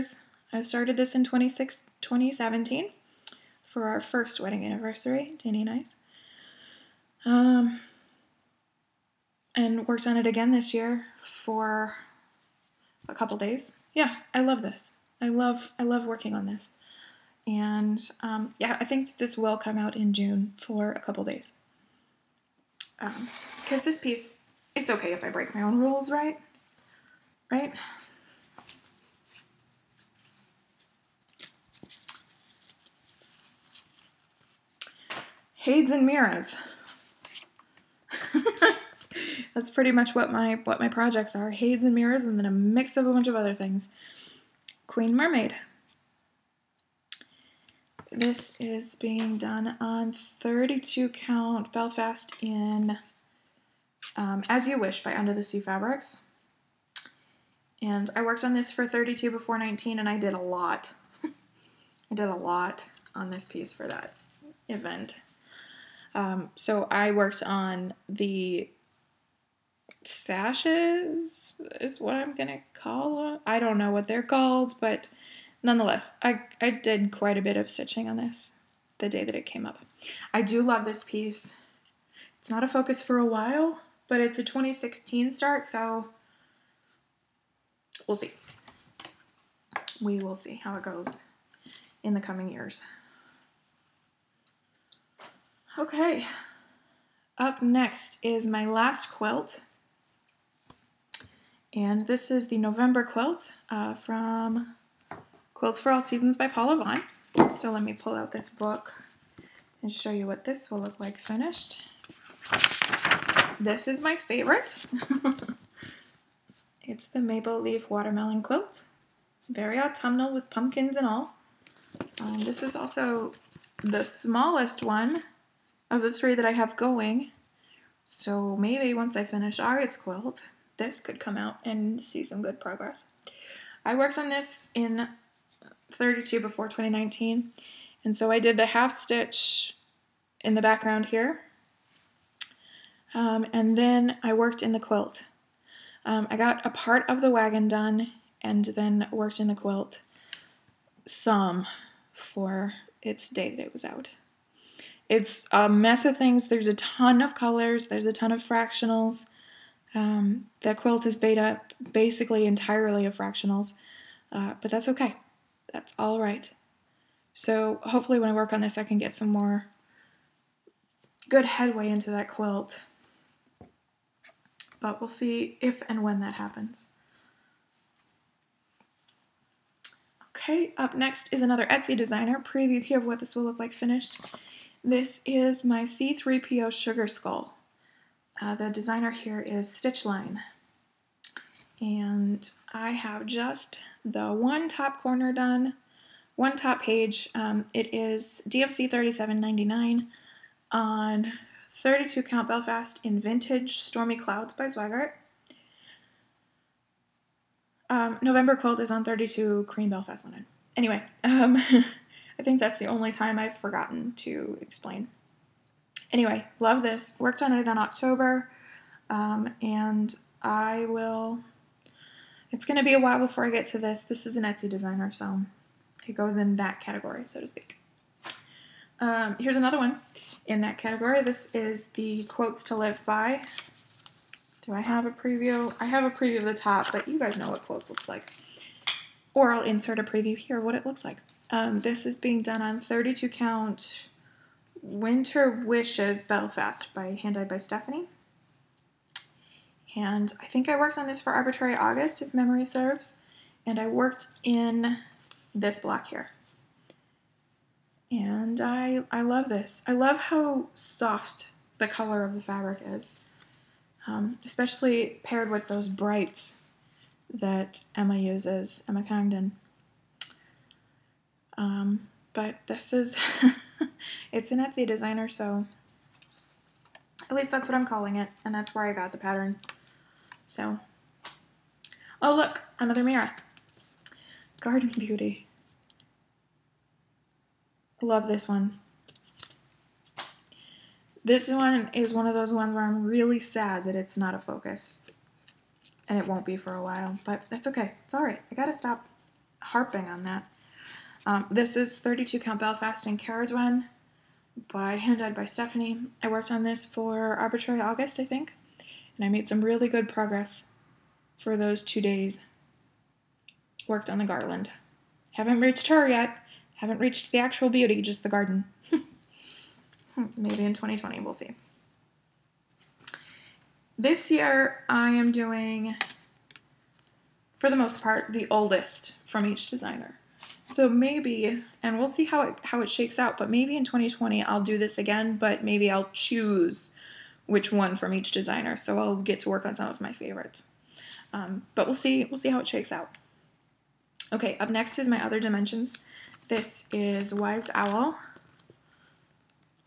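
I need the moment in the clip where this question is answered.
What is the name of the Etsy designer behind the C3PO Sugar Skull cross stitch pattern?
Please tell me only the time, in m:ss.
3:09.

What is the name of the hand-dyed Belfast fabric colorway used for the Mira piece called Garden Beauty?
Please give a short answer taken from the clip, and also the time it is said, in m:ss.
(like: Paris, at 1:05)
Caradwen, at 5:03.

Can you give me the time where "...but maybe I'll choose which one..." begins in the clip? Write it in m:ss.
5:35.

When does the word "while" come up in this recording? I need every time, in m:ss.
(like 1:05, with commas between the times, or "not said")
1:23, 3:42, 4:56.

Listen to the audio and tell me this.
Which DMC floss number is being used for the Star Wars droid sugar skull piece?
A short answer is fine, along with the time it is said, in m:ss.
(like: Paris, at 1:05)
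3799, at 3:18.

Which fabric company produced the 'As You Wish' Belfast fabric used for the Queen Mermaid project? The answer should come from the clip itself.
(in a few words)
Under the Sea Fabrics.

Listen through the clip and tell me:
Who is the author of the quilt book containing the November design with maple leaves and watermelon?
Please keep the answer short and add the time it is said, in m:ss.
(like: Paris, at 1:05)
Paula Vaughan, at 1:46.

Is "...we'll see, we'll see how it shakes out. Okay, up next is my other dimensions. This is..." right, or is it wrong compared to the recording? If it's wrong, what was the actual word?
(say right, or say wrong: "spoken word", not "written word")
right.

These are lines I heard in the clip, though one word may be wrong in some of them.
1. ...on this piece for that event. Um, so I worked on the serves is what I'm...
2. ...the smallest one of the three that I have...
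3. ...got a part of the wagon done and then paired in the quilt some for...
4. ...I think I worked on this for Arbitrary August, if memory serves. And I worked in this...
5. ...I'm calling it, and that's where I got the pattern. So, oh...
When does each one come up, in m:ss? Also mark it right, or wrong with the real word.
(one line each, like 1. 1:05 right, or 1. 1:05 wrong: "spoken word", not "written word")
1. 1:03 wrong: "sashes", not "serves"
2. 2:03 right
3. 2:26 wrong: "worked", not "paired"
4. 4:10 right
5. 4:37 right.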